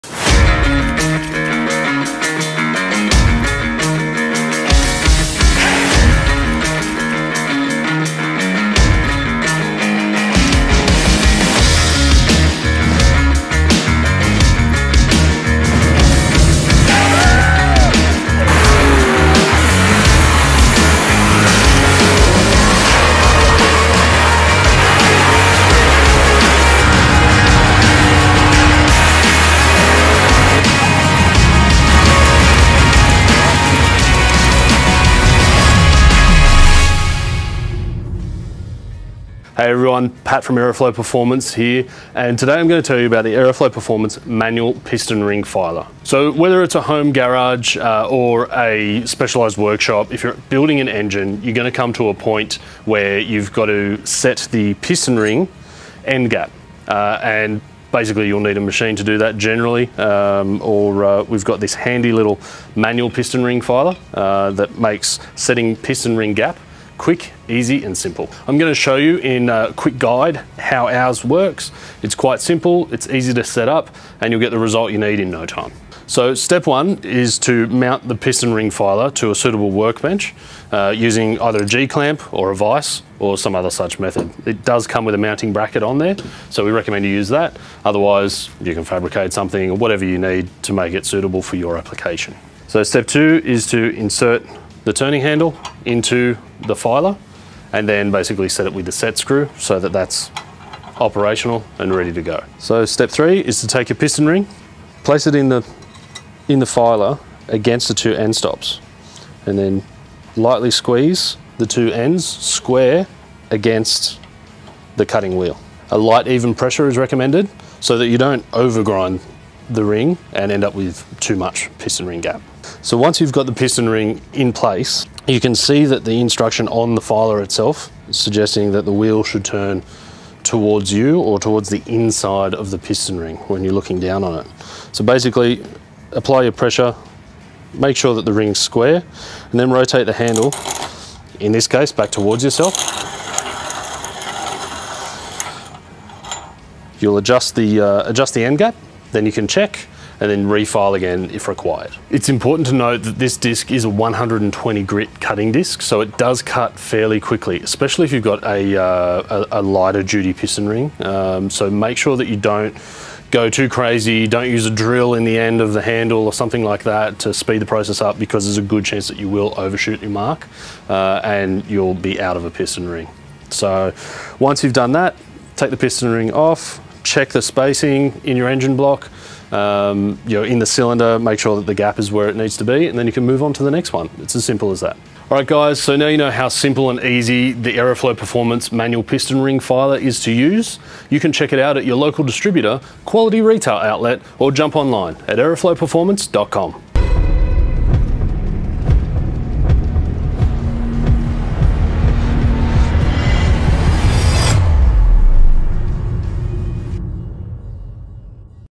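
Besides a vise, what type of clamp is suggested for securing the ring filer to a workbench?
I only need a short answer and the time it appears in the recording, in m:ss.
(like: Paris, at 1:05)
G-clamp, at 1:21.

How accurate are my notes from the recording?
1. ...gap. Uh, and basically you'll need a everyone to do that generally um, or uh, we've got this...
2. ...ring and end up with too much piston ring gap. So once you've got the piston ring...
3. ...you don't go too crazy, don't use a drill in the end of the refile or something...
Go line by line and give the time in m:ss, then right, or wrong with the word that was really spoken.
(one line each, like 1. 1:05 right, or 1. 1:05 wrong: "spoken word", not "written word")
1. 0:56 wrong: "machine", not "everyone"
2. 1:59 right
3. 2:42 wrong: "handle", not "refile".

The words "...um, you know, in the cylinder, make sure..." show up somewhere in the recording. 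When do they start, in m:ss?
2:59.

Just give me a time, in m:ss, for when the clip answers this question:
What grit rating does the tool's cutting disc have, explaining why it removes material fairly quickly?
2:33.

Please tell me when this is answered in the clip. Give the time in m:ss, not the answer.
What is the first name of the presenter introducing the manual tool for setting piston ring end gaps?
0:40.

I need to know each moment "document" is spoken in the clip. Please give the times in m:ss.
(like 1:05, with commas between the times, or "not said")
not said.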